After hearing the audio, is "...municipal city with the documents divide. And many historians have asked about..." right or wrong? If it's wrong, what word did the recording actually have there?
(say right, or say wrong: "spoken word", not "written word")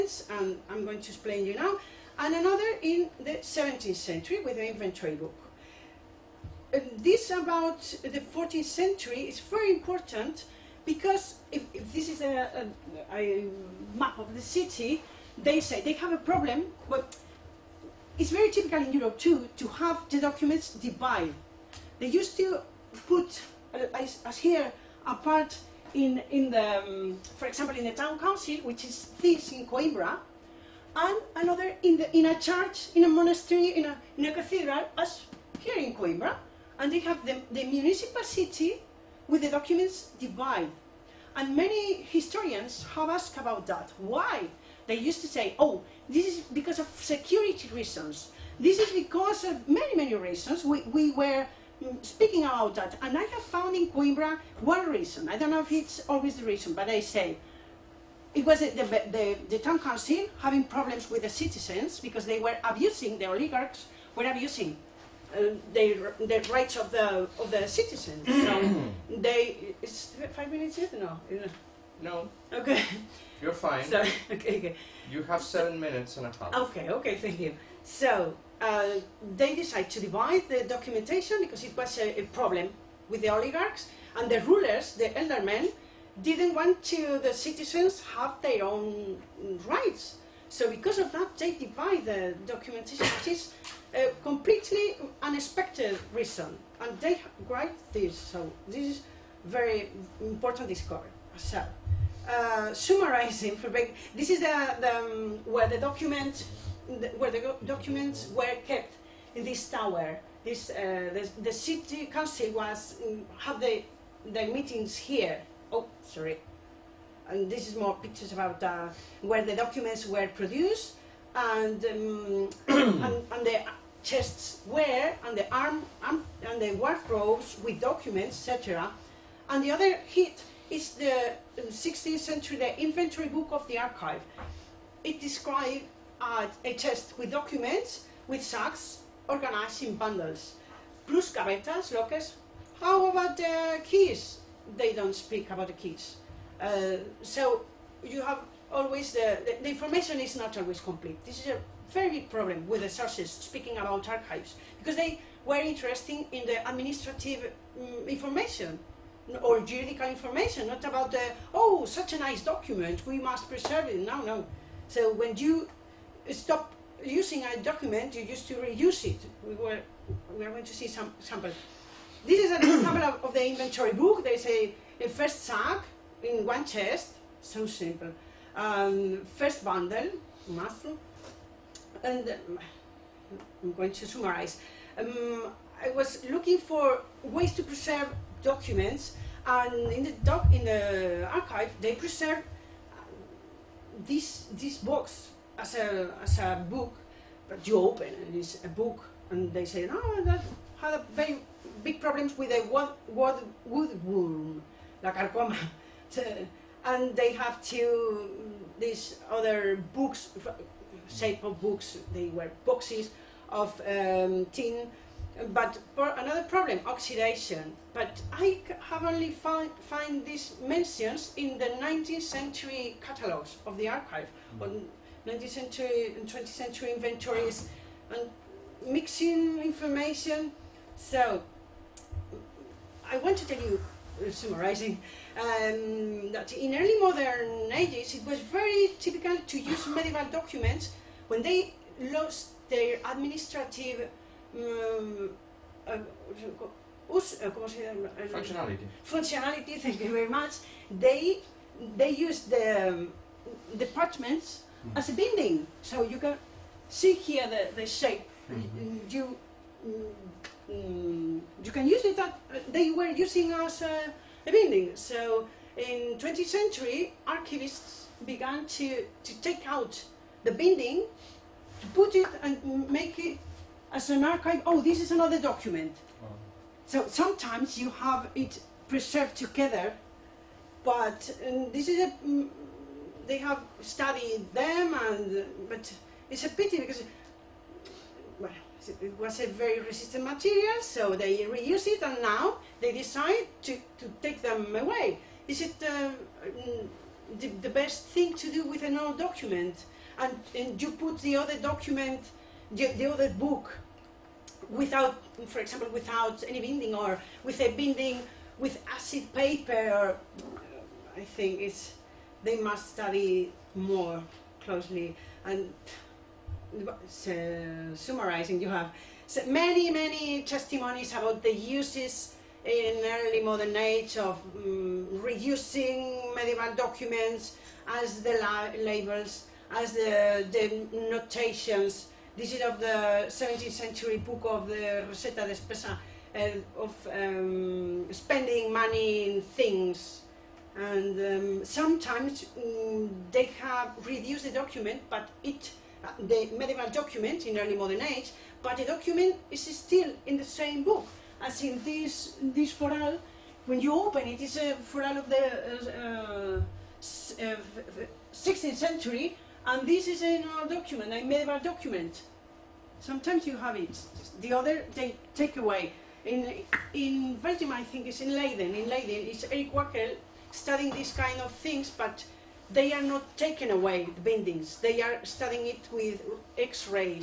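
right.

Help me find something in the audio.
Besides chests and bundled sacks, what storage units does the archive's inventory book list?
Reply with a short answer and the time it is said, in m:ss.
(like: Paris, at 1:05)
Gavetas (lockers), at 2:21.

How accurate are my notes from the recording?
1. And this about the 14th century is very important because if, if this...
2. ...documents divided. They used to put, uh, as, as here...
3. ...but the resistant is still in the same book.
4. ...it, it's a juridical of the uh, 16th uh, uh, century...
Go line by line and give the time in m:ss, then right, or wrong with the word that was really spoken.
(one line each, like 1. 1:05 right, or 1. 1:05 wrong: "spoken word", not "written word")
1. 0:06 right
2. 0:20 right
3. 5:48 wrong: "document", not "resistant"
4. 5:54 wrong: "foral", not "juridical".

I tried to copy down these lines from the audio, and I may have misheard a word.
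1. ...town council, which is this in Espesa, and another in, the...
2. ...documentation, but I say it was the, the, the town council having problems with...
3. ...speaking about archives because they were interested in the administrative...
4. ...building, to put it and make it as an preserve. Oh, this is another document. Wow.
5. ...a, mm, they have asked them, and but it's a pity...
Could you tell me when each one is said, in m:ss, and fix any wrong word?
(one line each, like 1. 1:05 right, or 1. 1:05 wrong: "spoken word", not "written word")
1. 0:27 wrong: "Coimbra", not "Espesa"
2. 0:56 wrong: "reason", not "documentation"
3. 2:33 right
4. 4:30 wrong: "archive", not "preserve"
5. 4:42 wrong: "studied", not "asked".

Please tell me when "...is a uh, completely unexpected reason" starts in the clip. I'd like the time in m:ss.
1:33.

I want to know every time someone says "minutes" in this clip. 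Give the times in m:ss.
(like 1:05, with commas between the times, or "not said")
1:10, 1:15.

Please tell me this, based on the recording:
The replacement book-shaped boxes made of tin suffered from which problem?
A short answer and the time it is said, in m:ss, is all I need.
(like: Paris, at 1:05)
Oxidation, at 3:36.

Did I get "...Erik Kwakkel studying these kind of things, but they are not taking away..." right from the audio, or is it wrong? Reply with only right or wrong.
right.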